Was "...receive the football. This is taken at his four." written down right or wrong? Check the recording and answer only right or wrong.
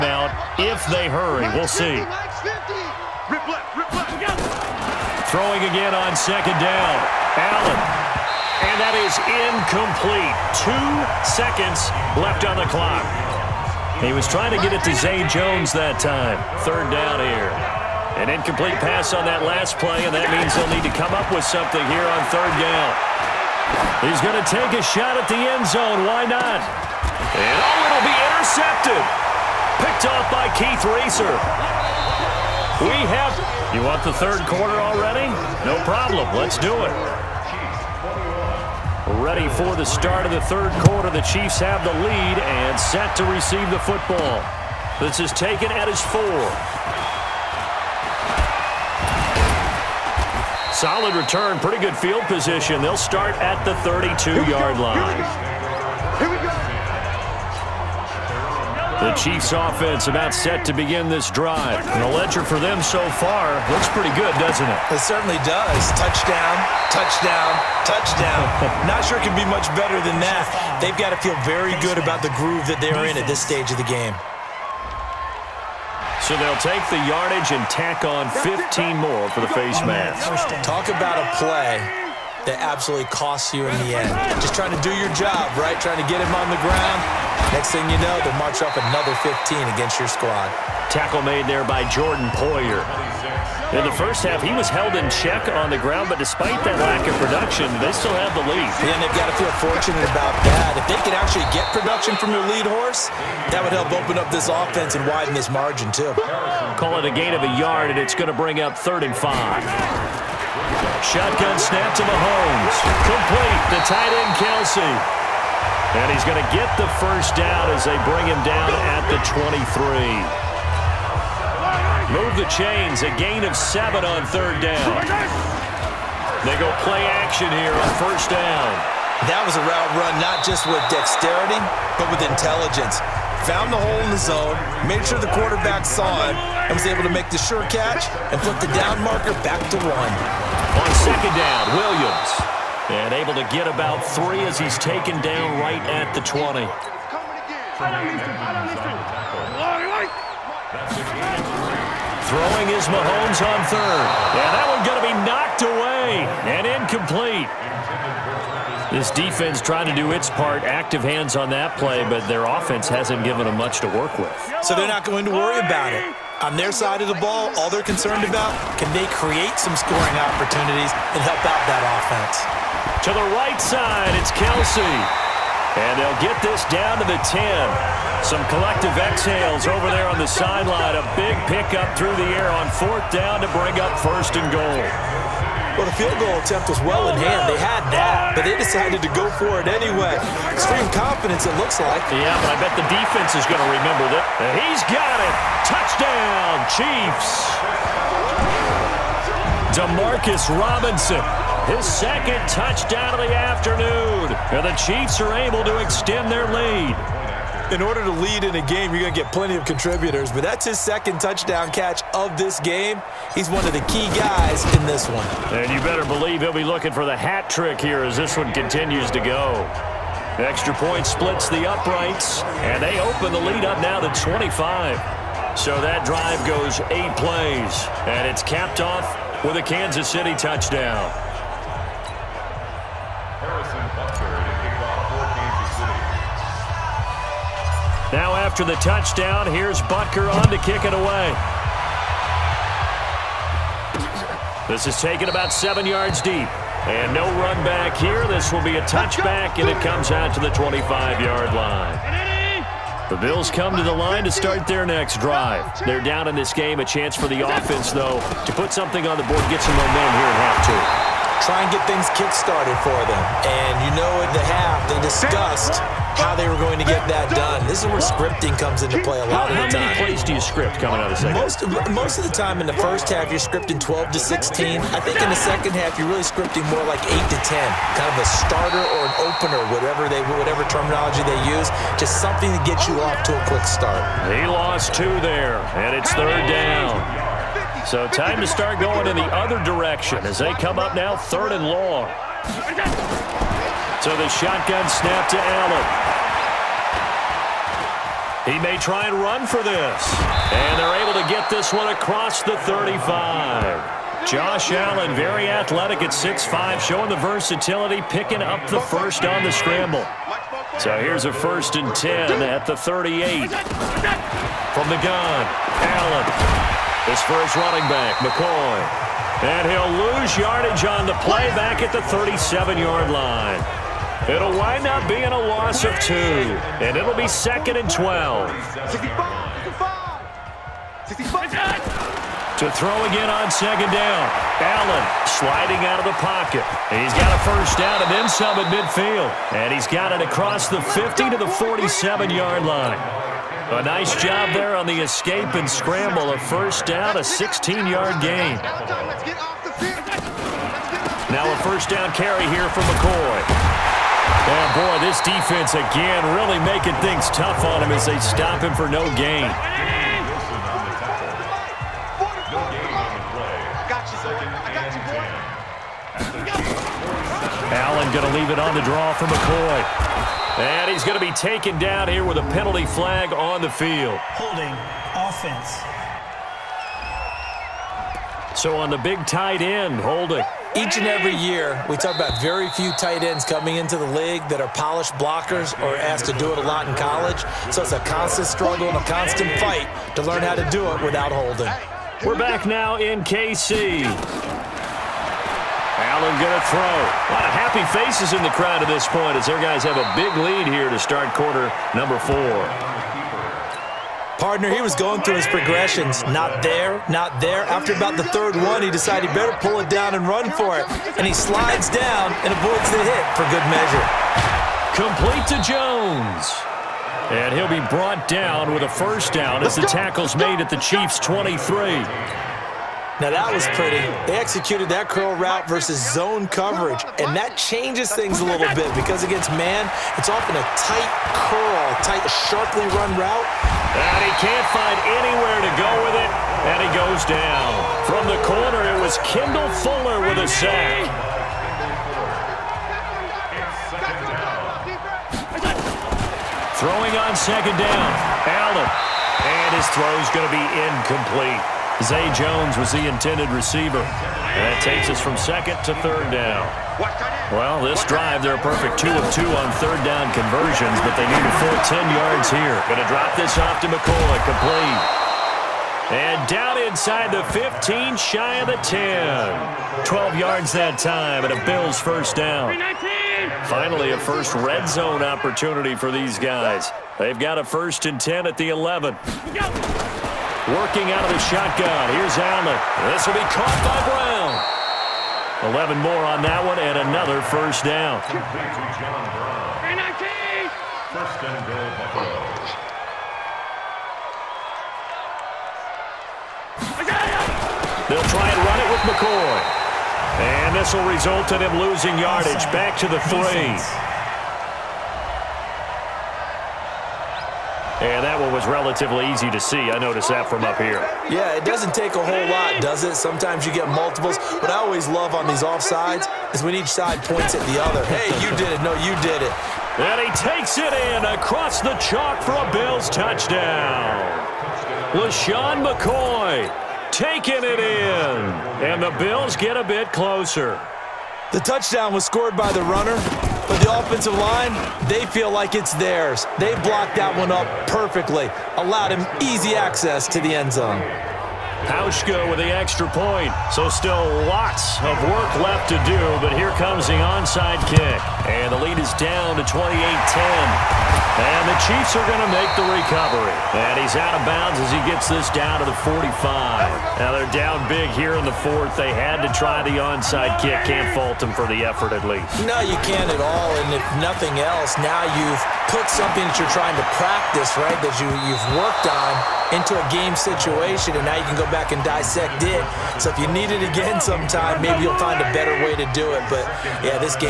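right.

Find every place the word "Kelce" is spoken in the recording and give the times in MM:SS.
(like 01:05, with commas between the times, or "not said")
01:54, 02:54.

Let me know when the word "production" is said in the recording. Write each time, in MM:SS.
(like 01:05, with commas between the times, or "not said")
01:37, 01:41.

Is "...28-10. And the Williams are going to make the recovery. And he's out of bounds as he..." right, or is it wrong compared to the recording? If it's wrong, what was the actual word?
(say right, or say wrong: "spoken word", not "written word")
wrong: "Chiefs", not "Williams".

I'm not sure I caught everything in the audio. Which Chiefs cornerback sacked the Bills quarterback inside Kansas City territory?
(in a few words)
Kendall Fuller.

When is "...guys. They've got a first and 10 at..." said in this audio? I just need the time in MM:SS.
07:56.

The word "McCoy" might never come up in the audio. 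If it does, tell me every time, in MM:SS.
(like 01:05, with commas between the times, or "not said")
05:18, 05:52, 06:09, 08:19, 08:45.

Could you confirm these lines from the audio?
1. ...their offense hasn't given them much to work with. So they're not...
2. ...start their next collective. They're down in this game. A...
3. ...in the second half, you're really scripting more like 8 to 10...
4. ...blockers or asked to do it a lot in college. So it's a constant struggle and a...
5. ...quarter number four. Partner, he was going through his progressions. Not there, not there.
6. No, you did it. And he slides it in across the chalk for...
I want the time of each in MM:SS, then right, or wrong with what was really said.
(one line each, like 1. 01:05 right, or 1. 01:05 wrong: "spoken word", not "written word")
1. 02:42 right
2. 04:14 wrong: "drive", not "collective"
3. 04:35 right
4. 06:25 right
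5. 06:41 right
6. 08:38 wrong: "takes", not "slides".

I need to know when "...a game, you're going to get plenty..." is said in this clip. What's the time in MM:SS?
03:28.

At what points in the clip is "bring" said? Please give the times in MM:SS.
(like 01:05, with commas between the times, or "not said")
01:48, 01:58, 03:03.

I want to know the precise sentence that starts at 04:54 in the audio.
So the shotgun snap to Allen.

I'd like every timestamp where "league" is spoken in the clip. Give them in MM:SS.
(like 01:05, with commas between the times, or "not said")
06:24.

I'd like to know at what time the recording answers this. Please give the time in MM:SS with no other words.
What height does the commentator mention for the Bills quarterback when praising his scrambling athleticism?
05:06.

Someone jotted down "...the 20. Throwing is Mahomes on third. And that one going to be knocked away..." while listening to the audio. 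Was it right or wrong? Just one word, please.
right.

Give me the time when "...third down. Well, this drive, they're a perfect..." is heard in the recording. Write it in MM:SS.
07:36.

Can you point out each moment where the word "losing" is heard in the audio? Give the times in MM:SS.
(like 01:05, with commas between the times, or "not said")
08:21.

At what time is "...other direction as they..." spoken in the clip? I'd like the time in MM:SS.
04:49.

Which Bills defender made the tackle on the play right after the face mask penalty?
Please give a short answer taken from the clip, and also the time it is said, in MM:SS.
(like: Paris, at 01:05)
Jordan Poyer, at 01:31.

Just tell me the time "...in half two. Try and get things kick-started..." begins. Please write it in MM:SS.
04:20.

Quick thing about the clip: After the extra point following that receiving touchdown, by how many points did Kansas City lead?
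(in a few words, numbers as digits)
25.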